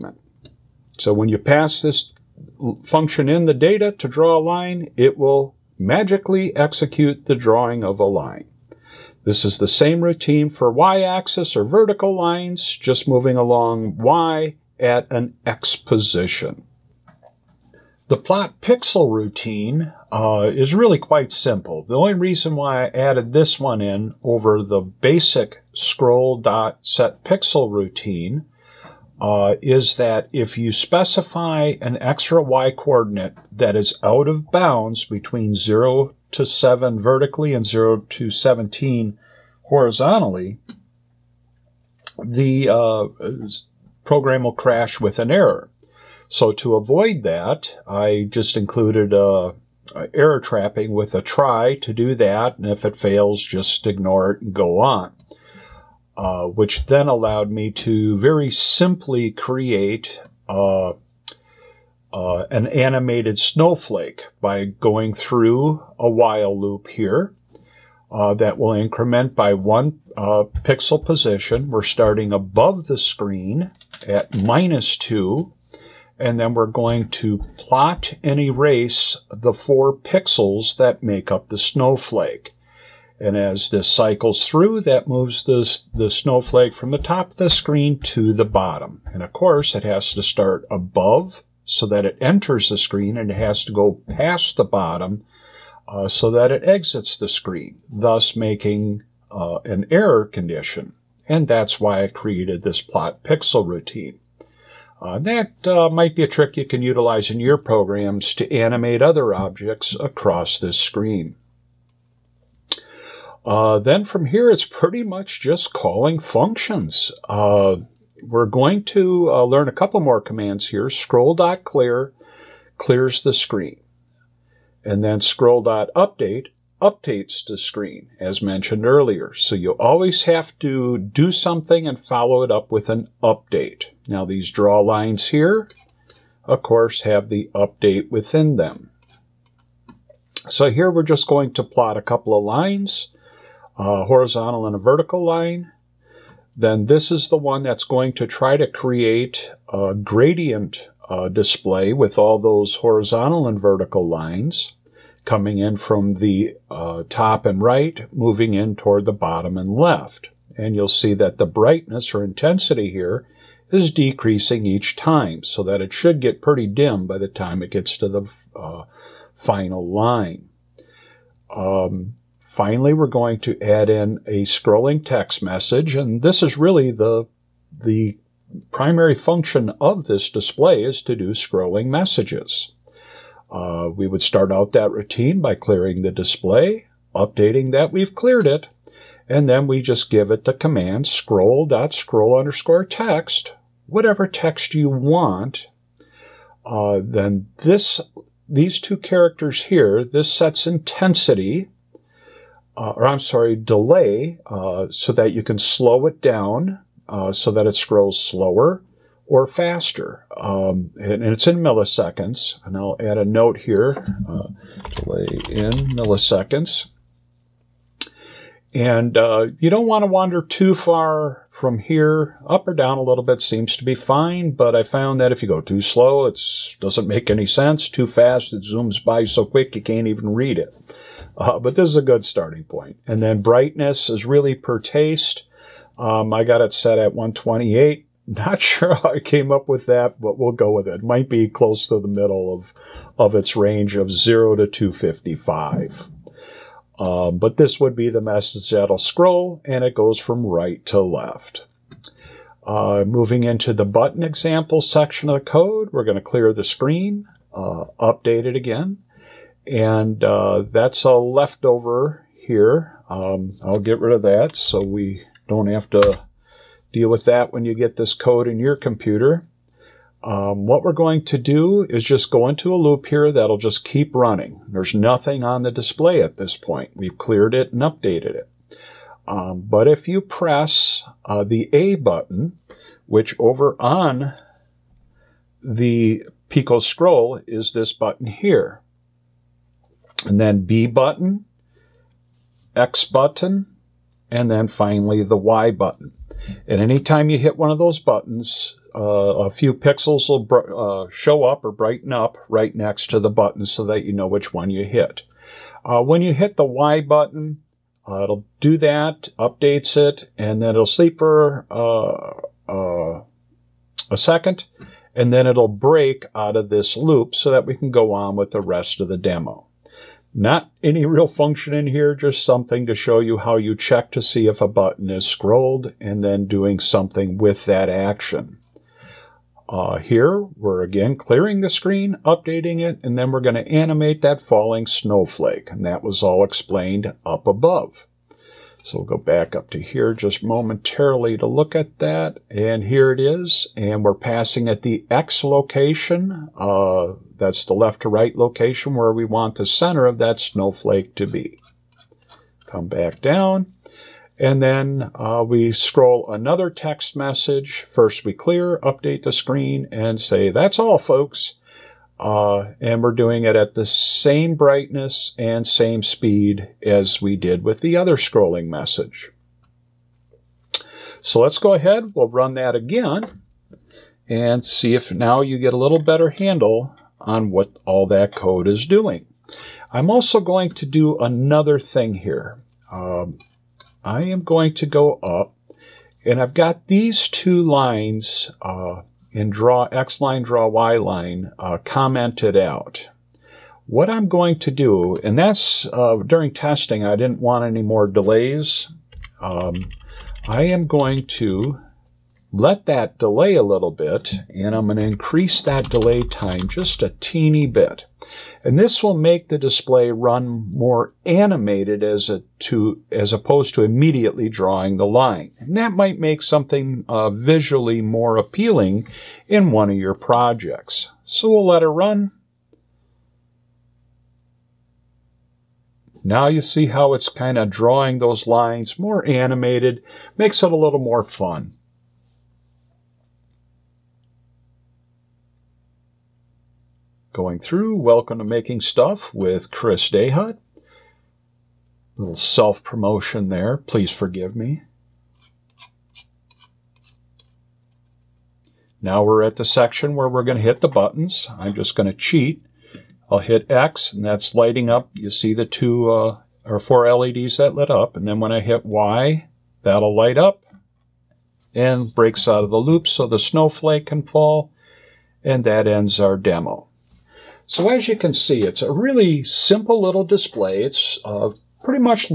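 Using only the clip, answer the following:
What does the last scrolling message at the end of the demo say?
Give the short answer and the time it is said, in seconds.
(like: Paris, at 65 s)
That's all, folks, at 360 s.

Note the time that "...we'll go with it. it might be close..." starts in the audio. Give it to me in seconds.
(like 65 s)
240 s.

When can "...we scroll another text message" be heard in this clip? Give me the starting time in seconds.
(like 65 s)
355 s.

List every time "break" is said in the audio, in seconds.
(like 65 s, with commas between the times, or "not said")
315 s, 462 s.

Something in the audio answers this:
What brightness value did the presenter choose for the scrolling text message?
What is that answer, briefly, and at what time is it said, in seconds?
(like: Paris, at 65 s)
128, at 237 s.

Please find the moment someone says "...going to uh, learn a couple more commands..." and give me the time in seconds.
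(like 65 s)
118 s.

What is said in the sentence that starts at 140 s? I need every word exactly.
So here we're just going to plot a couple of lines, a horizontal and a vertical line.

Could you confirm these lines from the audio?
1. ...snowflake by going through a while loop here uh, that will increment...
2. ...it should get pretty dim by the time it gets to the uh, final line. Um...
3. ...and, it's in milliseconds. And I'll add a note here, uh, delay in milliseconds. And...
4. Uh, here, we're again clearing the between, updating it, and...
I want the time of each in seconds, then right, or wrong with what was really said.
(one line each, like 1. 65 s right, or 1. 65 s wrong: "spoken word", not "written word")
1. 63 s right
2. 165 s right
3. 211 s right
4. 329 s wrong: "screen", not "between".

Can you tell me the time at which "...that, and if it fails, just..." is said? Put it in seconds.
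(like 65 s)
52 s.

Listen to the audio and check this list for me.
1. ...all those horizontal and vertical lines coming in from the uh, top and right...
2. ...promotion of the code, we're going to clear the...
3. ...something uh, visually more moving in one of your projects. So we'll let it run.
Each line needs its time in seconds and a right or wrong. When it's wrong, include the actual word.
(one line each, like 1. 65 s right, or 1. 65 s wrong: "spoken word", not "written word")
1. 152 s right
2. 254 s wrong: "section", not "promotion"
3. 416 s wrong: "appealing", not "moving".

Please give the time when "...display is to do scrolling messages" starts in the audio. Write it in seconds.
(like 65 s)
180 s.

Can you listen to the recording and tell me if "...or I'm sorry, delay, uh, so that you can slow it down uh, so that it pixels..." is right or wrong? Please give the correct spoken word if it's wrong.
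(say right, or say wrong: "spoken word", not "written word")
wrong: "scrolls", not "pixels".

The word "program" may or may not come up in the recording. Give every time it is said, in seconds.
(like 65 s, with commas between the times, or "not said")
44 s, 107 s.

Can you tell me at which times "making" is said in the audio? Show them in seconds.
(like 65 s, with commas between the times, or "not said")
98 s, 438 s.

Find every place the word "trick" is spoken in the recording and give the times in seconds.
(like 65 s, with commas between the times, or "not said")
106 s.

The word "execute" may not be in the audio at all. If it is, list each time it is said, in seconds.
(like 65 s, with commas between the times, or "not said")
6 s.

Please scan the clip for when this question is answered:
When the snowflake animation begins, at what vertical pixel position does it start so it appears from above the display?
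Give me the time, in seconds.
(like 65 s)
74 s.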